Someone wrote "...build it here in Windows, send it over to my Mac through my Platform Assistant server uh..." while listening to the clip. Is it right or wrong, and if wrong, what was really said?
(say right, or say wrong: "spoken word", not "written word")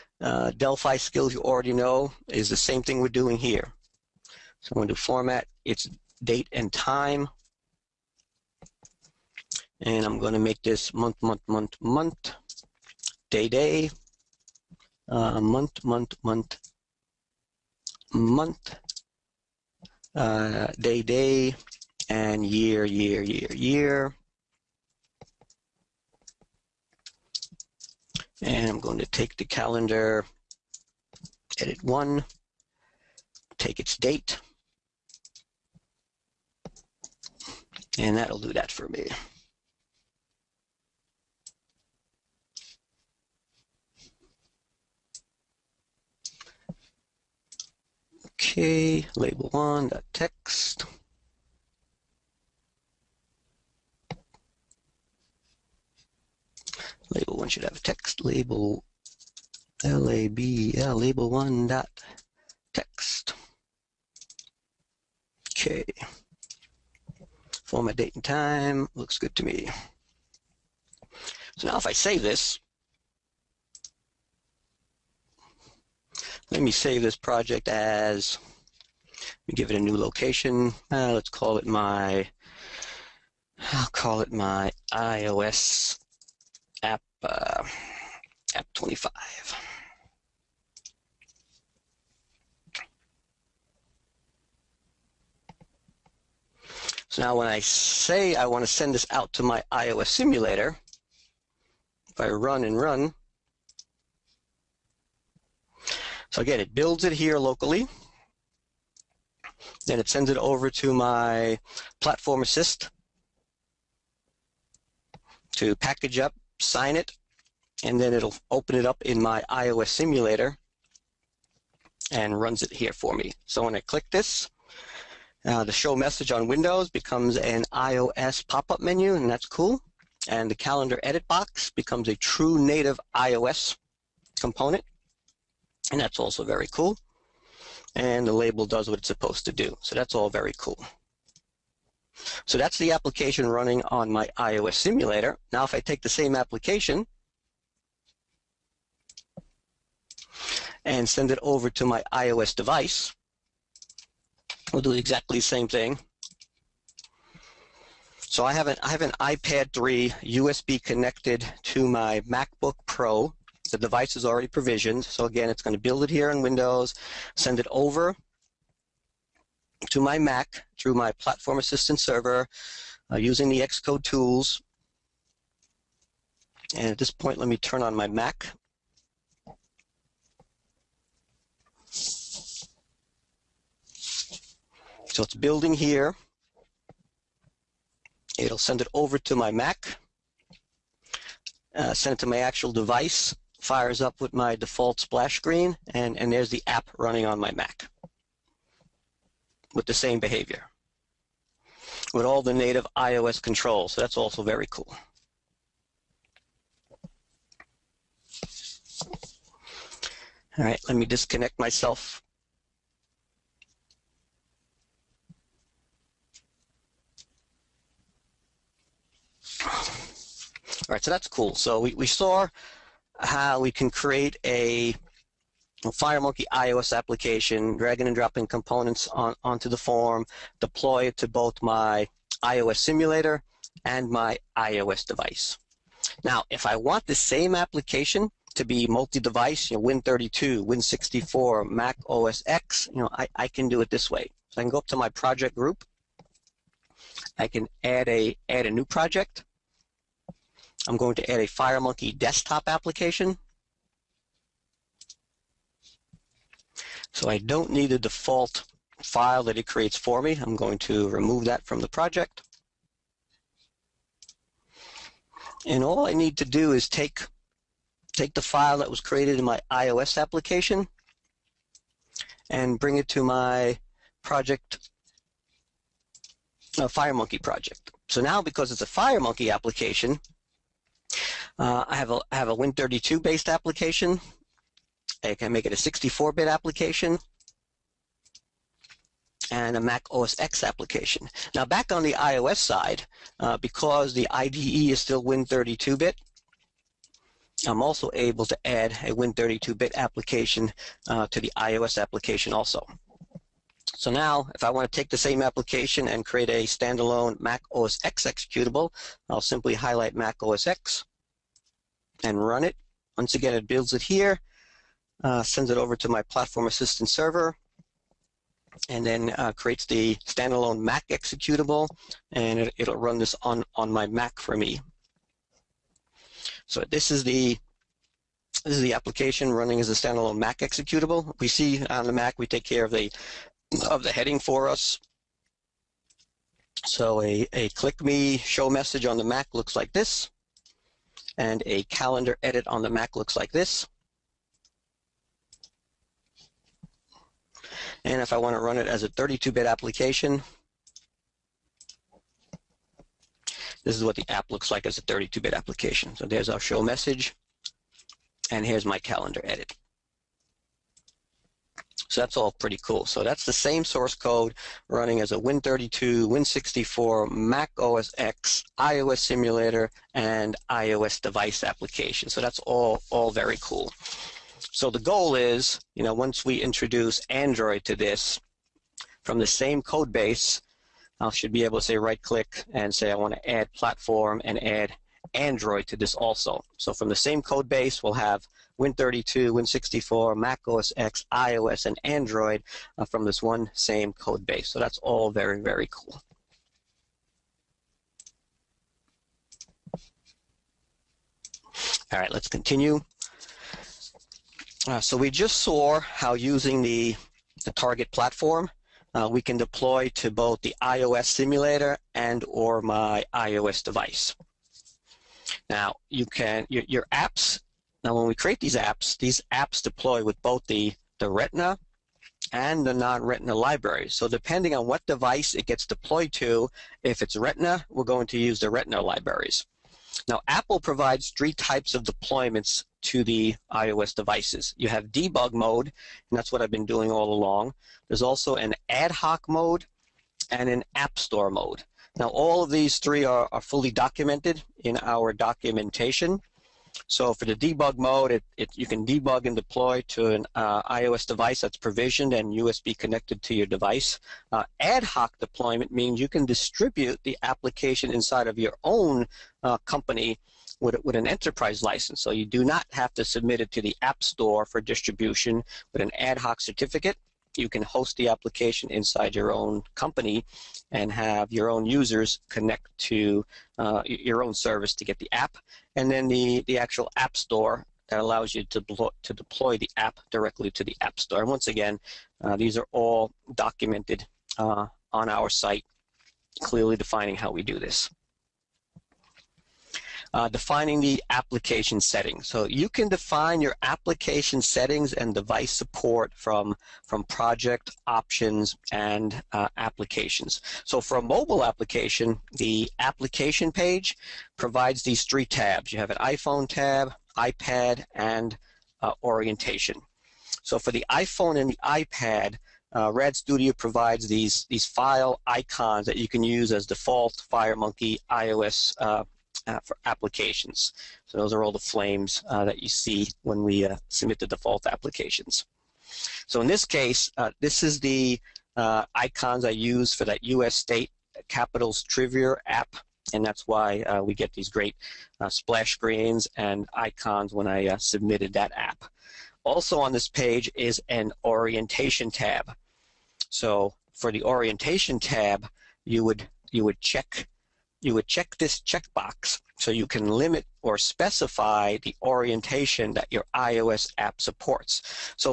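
right.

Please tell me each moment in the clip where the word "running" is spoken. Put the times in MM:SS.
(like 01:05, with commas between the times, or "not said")
02:23, 03:16, 05:29, 06:04.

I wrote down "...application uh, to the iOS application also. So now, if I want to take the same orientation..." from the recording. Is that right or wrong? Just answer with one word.
wrong.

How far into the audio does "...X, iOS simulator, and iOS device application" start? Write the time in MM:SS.
06:08.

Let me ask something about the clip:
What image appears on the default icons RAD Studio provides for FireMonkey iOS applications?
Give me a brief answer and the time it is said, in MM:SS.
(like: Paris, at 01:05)
flames, at 08:41.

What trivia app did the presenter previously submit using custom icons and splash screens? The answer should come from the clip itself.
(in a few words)
U.S. state capitals trivia.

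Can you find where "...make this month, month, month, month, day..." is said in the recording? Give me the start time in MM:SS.
00:10.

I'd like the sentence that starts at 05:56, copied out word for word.
So there's our show message, and here's my calendar edit.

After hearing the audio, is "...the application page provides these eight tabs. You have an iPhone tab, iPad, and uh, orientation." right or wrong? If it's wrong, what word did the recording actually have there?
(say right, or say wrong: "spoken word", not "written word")
wrong: "three", not "eight".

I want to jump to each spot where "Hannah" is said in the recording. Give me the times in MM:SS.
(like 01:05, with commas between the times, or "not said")
not said.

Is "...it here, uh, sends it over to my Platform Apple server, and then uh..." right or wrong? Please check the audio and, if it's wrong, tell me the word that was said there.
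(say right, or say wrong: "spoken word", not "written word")
wrong: "Assistant", not "Apple".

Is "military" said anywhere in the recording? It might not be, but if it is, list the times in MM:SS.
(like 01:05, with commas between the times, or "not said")
not said.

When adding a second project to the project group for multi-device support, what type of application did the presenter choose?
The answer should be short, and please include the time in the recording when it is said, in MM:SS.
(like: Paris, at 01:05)
FireMonkey desktop application, at 04:11.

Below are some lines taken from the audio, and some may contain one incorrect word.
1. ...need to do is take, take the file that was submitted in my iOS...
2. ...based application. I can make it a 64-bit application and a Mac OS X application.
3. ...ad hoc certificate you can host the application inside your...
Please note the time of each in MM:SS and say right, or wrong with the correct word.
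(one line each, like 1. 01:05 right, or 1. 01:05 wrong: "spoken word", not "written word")
1. 04:26 wrong: "created", not "submitted"
2. 04:43 right
3. 07:46 right.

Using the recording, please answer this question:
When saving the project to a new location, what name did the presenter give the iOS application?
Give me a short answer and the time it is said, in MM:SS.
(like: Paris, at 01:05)
my iOS app 25, at 01:24.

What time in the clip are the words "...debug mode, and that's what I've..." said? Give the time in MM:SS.
07:15.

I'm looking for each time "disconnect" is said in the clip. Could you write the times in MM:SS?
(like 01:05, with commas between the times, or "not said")
03:31.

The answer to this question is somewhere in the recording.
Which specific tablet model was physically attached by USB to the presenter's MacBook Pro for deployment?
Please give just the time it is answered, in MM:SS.
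02:39.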